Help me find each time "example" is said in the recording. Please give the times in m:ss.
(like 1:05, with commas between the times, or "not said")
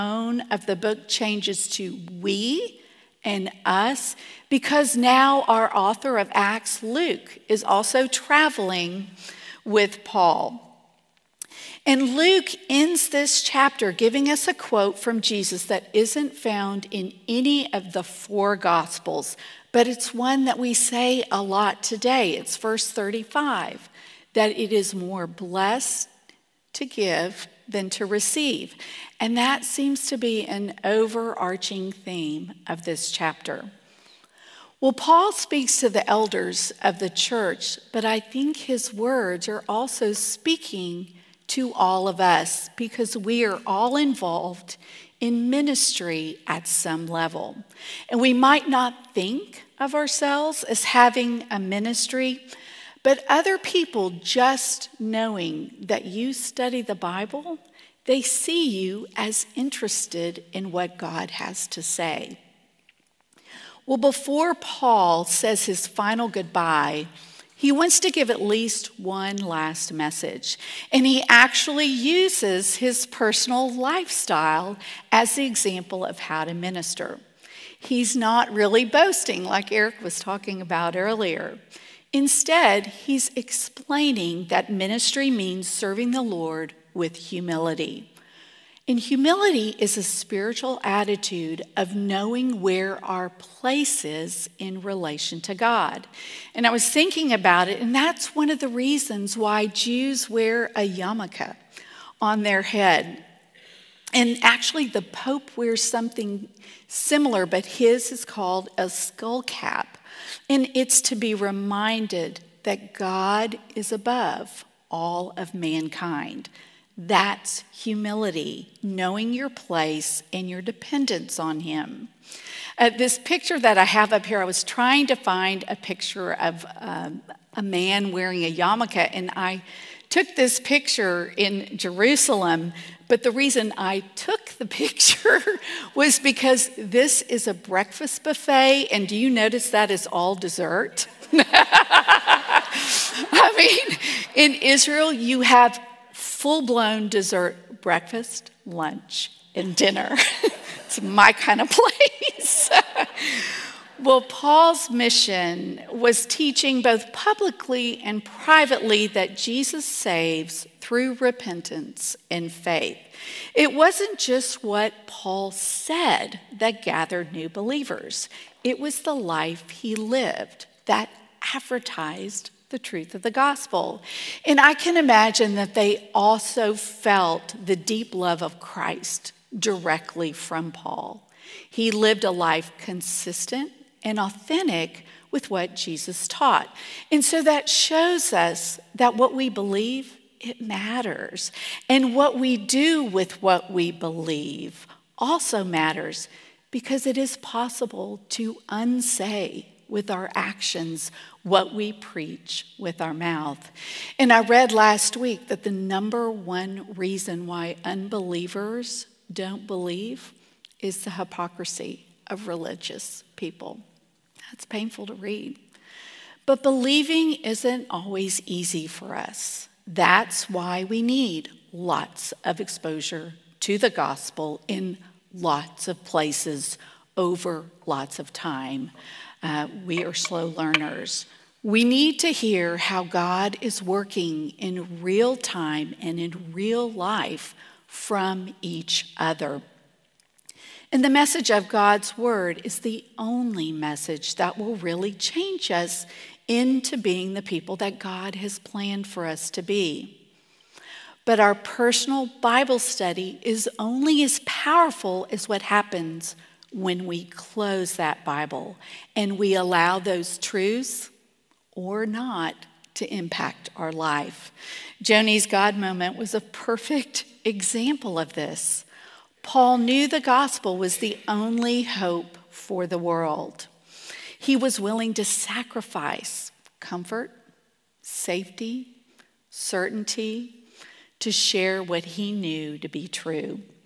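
1:15, 4:27.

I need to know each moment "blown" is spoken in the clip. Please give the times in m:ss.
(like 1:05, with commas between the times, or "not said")
2:26.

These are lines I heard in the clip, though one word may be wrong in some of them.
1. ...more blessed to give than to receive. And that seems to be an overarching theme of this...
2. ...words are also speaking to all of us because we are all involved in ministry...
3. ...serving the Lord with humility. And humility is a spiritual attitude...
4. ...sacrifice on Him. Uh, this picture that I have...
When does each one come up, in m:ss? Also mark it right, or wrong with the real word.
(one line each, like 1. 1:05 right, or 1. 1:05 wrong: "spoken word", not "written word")
1. 0:24 right
2. 0:38 right
3. 1:25 right
4. 2:00 wrong: "dependence", not "sacrifice".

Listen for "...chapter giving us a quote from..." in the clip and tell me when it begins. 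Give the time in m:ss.
0:13.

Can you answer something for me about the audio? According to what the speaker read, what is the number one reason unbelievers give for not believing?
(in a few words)
hypocrisy of religious people.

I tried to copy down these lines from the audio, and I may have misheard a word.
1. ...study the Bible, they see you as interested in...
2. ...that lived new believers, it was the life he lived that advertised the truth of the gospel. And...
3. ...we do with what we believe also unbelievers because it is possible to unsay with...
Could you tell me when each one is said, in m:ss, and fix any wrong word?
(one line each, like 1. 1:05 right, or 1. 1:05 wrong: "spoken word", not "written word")
1. 0:56 right
2. 2:46 wrong: "gathered", not "lived"
3. 3:12 wrong: "matters", not "unbelievers".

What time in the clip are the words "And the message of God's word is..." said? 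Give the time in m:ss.
4:00.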